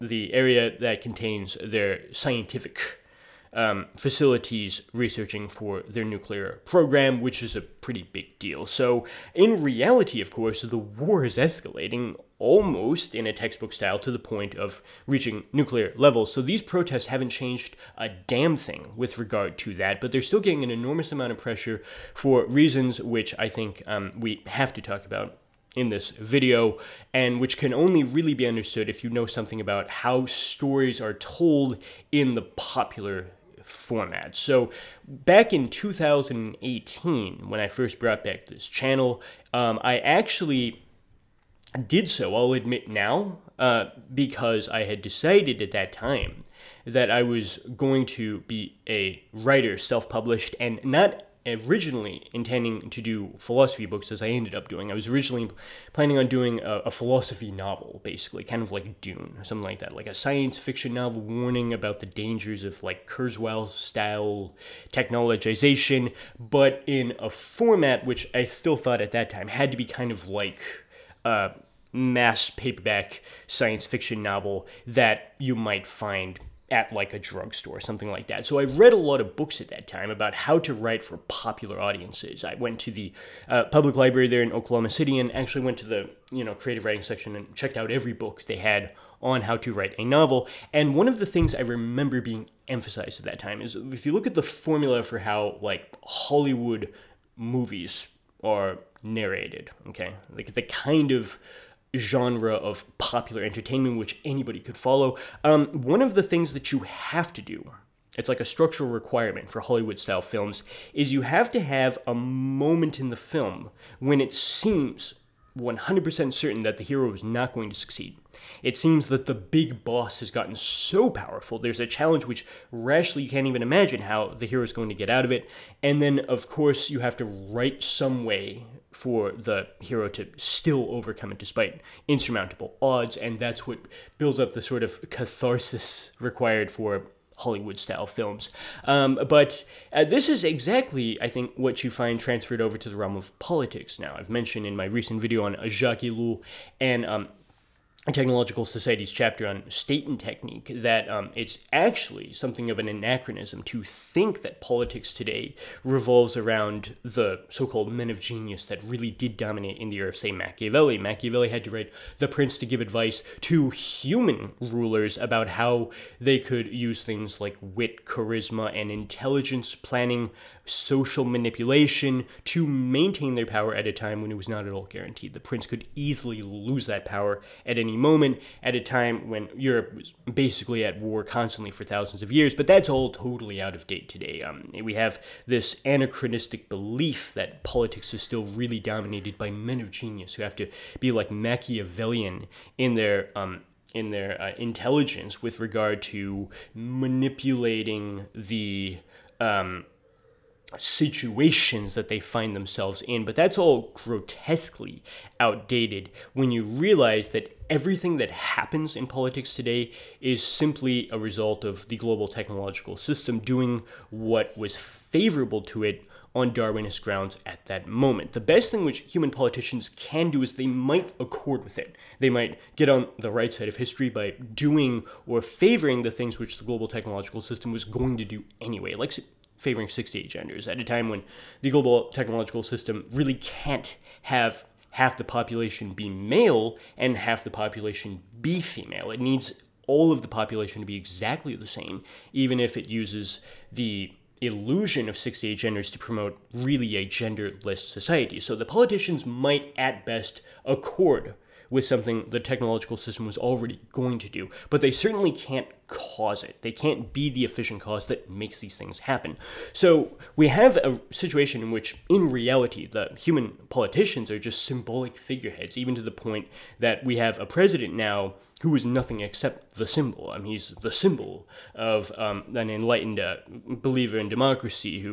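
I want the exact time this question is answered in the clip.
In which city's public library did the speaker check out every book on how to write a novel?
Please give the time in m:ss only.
1:24.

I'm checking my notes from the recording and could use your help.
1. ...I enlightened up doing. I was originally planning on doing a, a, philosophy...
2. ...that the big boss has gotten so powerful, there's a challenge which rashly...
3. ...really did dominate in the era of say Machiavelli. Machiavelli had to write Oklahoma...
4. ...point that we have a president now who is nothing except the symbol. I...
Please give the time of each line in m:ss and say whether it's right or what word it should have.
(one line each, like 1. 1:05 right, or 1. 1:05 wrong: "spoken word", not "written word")
1. 0:54 wrong: "ended", not "enlightened"
2. 1:59 right
3. 2:38 wrong: "The", not "Oklahoma"
4. 4:26 right.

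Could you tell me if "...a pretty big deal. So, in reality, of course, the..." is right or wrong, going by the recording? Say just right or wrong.
right.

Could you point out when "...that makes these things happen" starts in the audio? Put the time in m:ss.
4:18.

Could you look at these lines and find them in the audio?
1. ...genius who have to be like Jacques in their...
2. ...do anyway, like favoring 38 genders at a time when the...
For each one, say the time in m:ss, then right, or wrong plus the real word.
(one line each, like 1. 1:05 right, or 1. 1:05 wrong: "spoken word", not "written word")
1. 3:09 wrong: "Machiavellian", not "Jacques"
2. 3:48 wrong: "68", not "38".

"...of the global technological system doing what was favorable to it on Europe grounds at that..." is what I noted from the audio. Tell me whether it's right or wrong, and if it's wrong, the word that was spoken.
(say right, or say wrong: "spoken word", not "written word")
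wrong: "Darwinist", not "Europe".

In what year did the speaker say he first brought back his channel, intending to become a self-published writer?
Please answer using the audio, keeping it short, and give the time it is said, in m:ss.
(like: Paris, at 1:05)
2018, at 0:35.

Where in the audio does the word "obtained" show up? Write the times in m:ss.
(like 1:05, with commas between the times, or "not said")
not said.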